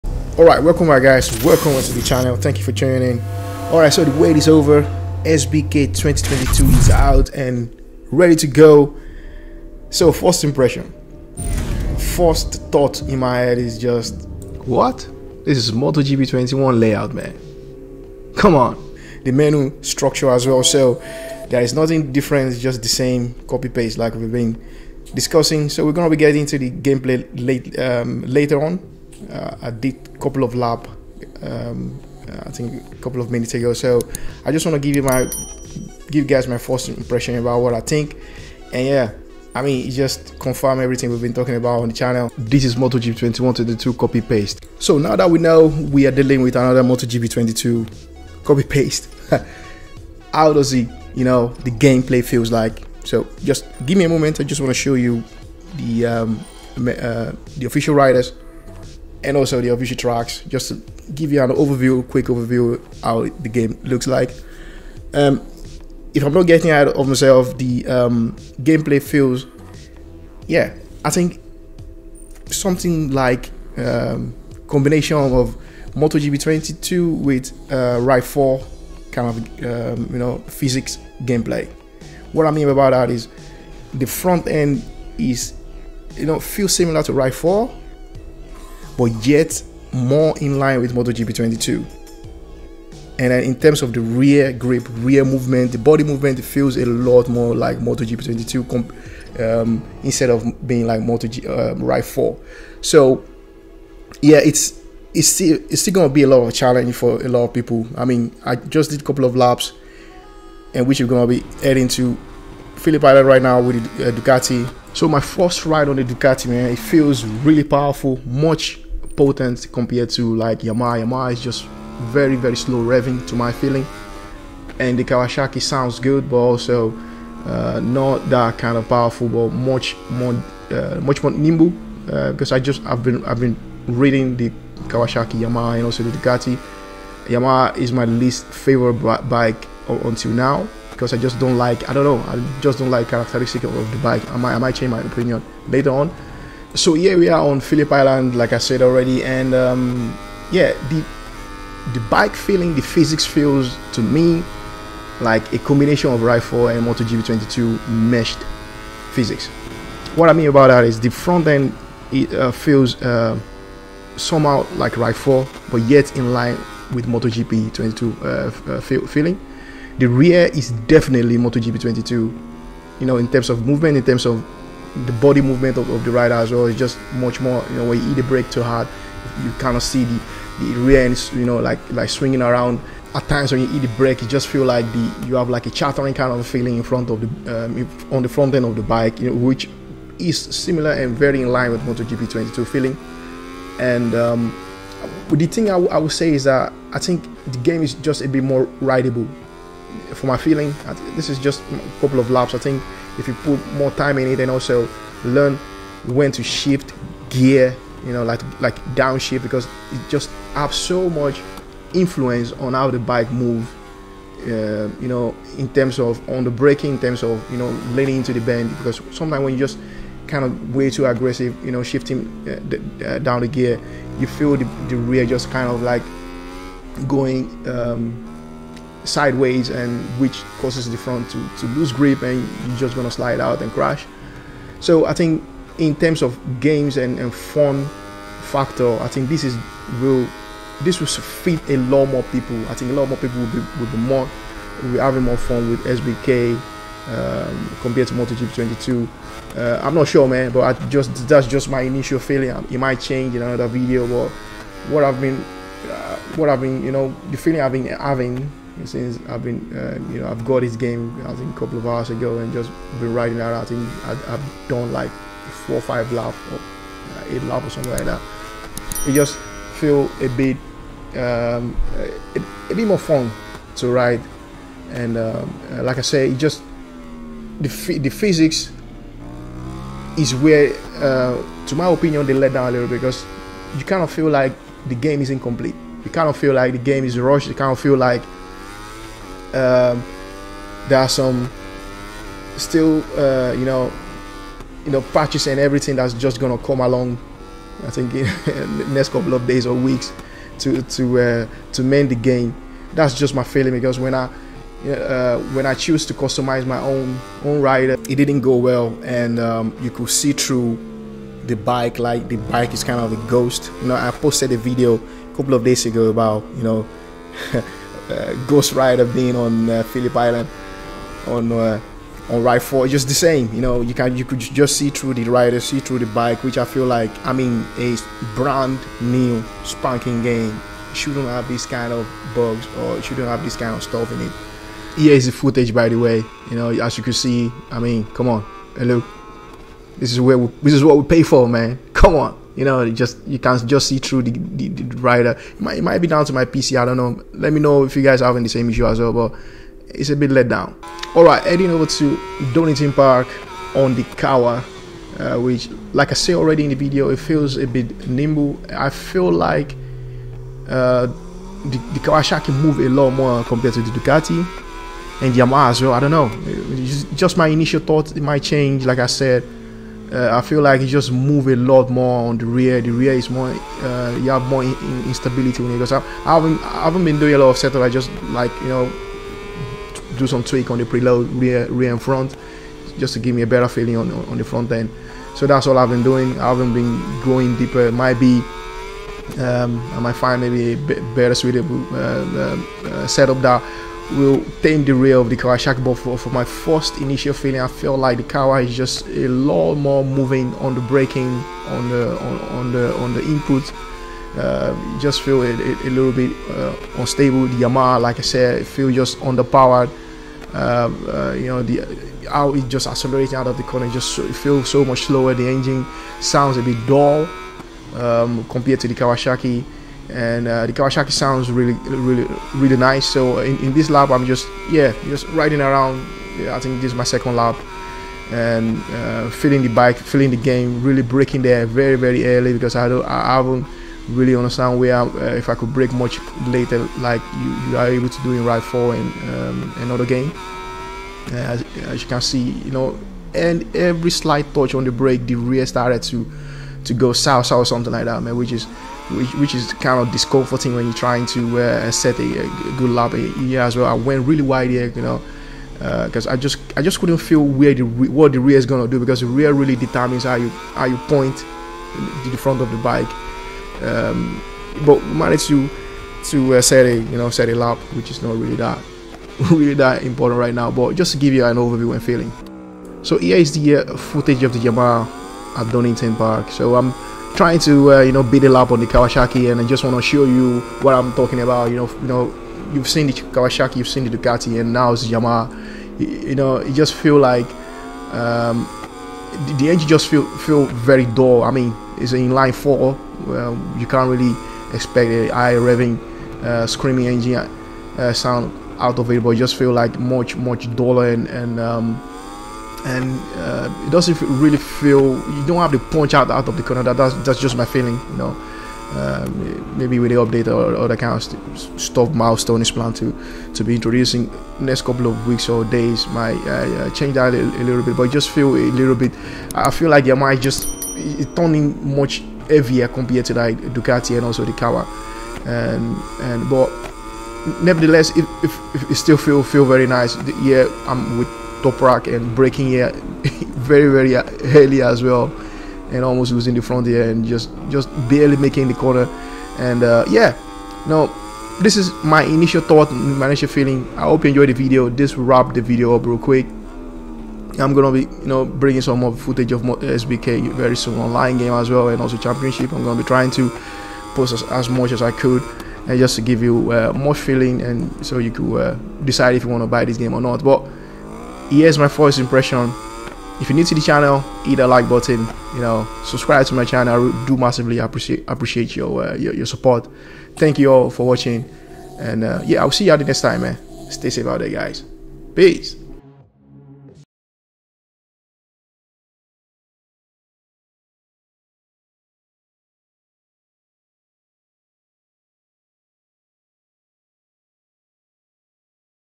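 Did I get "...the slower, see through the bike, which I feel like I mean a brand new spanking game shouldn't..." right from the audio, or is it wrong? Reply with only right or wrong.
wrong.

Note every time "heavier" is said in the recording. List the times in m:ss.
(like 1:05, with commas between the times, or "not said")
8:42.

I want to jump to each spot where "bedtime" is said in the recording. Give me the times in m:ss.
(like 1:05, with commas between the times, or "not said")
not said.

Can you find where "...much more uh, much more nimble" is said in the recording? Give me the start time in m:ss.
2:09.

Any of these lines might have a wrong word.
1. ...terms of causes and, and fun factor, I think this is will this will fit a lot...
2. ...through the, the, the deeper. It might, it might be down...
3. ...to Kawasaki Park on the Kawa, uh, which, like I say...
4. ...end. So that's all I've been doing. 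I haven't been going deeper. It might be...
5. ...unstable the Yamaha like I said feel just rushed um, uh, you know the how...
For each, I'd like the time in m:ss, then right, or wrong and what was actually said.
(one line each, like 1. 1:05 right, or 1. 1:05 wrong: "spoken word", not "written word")
1. 3:55 wrong: "games", not "causes"
2. 5:43 wrong: "rider", not "deeper"
3. 5:51 wrong: "Donington", not "Kawasaki"
4. 6:24 right
5. 6:46 wrong: "underpowered", not "rushed".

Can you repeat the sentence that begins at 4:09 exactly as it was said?
Uh, I'm not sure, man, but I just that's just my initial feeling.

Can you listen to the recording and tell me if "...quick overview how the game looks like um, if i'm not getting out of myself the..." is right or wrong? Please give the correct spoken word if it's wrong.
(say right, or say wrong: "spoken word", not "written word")
right.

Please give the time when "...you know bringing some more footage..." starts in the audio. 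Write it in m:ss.
9:08.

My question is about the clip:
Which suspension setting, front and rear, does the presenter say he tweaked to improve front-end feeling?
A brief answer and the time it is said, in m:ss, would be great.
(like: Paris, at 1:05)
preload, at 6:20.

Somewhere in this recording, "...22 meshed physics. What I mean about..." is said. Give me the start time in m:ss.
2:37.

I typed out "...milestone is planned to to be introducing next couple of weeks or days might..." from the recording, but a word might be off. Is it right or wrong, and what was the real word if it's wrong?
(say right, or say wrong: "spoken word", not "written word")
right.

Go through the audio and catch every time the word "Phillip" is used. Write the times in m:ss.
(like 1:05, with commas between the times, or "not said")
1:52, 2:27, 5:19.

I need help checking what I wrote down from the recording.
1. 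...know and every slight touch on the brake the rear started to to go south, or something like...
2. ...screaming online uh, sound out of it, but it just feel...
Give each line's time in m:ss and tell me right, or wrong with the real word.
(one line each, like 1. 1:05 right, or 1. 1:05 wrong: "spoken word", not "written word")
1. 7:22 right
2. 8:16 wrong: "engine", not "online".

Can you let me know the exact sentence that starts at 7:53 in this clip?
So here is the uh, footage of the Yamaha at Donington Park.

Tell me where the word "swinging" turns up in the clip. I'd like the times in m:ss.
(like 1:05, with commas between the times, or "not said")
3:02.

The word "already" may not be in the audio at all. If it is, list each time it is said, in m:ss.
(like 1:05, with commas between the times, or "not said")
2:28, 5:56.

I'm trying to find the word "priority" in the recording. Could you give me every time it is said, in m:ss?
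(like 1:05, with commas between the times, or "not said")
not said.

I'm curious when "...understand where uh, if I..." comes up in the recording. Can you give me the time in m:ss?
7:14.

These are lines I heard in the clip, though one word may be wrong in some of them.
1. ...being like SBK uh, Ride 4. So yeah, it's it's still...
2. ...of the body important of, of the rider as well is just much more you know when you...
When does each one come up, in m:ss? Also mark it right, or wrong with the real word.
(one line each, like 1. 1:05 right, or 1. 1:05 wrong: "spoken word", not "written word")
1. 1:40 wrong: "Moto", not "SBK"
2. 2:54 wrong: "movement", not "important".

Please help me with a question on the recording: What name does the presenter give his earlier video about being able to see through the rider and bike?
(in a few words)
Ghost Rider.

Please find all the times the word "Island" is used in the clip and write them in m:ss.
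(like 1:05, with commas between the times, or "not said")
1:53, 2:27, 5:20.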